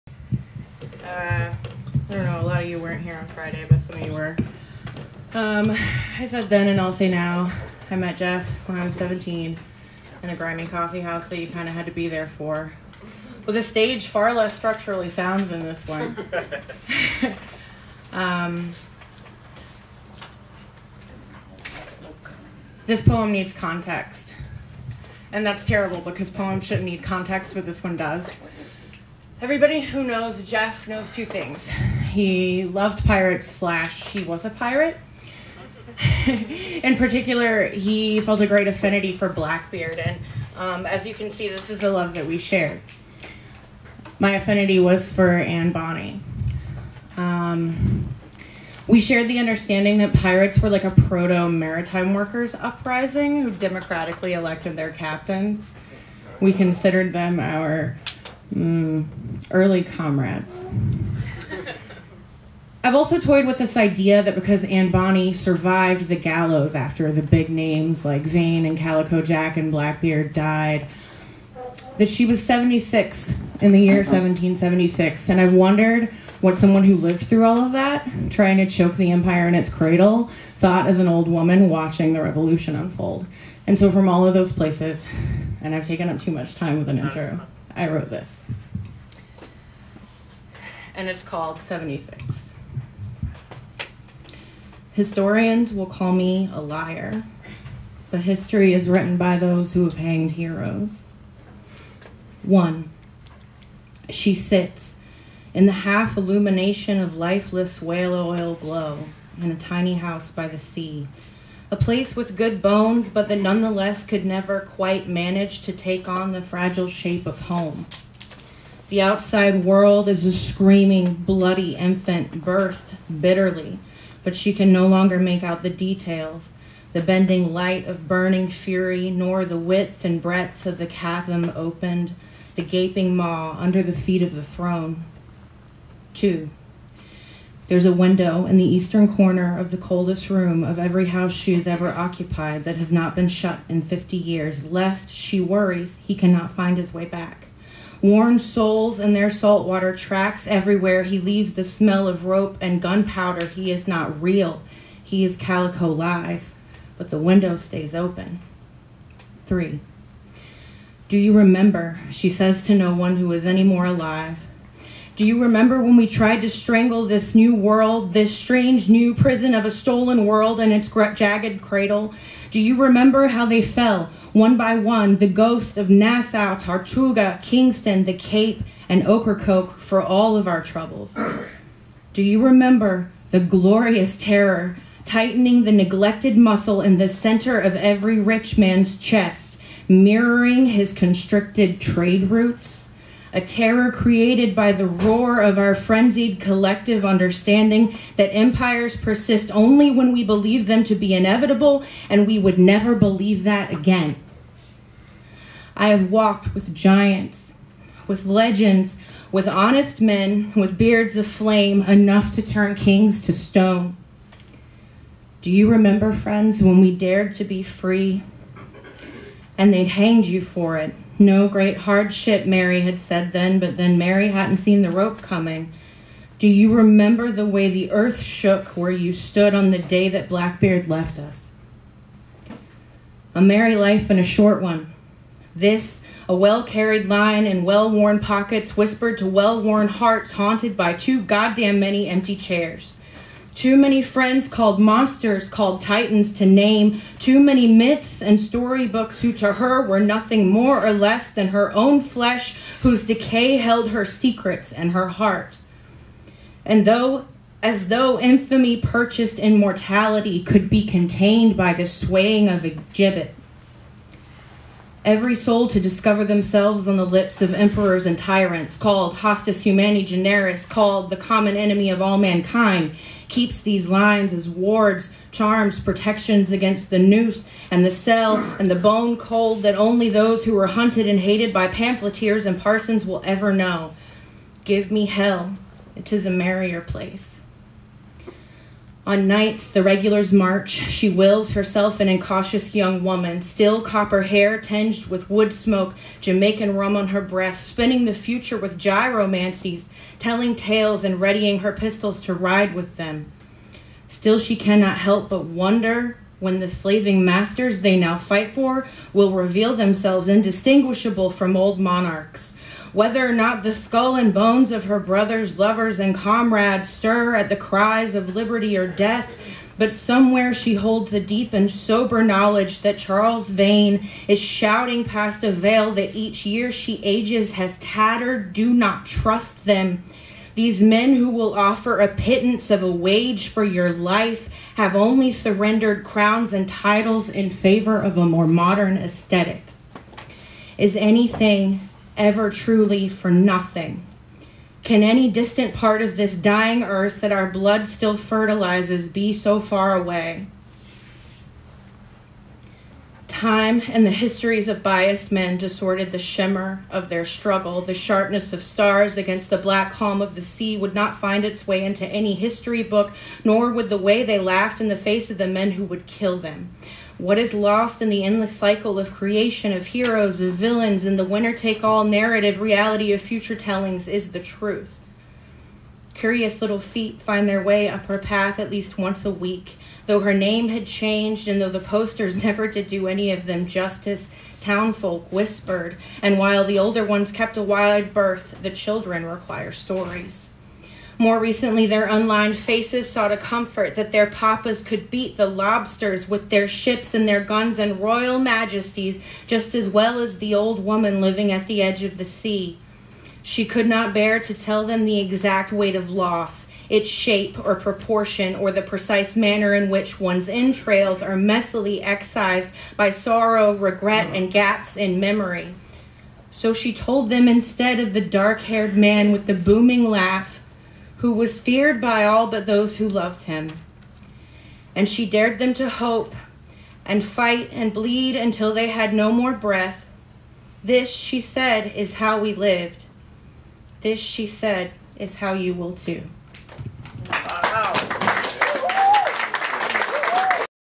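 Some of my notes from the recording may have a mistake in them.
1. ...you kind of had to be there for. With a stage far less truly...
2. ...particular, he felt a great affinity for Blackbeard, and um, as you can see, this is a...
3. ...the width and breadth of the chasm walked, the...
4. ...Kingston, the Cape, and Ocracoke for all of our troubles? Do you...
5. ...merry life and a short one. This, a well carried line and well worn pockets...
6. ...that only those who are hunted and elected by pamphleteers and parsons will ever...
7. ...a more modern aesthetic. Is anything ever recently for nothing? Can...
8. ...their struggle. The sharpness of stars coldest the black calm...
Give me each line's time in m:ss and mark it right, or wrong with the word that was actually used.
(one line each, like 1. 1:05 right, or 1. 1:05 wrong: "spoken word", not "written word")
1. 0:11 wrong: "structurally", not "truly"
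2. 0:36 right
3. 2:09 wrong: "opened", not "walked"
4. 2:57 right
5. 3:53 right
6. 4:39 wrong: "hated", not "elected"
7. 5:38 wrong: "truly", not "recently"
8. 5:57 wrong: "against", not "coldest".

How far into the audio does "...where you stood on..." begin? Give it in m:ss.
3:48.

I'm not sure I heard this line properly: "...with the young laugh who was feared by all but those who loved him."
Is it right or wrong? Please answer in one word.
wrong.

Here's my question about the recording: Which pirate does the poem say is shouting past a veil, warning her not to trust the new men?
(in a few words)
Charles Vane.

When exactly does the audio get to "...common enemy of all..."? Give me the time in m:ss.
4:31.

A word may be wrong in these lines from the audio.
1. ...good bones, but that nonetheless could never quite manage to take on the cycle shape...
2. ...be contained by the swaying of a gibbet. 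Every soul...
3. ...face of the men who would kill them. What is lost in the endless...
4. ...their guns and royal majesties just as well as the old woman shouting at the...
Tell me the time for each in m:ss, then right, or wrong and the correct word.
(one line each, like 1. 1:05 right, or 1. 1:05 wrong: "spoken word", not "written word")
1. 1:52 wrong: "fragile", not "cycle"
2. 4:20 right
3. 6:04 right
4. 6:37 wrong: "living", not "shouting".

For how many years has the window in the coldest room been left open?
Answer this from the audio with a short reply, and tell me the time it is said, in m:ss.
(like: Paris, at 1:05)
50, at 2:23.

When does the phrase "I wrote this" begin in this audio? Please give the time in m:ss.
1:27.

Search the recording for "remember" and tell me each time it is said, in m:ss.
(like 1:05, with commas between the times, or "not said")
2:41, 2:45, 2:52, 3:02, 3:35, 3:46.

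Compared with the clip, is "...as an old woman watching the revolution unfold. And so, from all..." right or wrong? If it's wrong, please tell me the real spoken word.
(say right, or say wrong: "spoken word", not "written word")
right.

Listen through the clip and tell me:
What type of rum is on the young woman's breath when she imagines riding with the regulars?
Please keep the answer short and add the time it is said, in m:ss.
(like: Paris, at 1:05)
Jamaican rum, at 4:56.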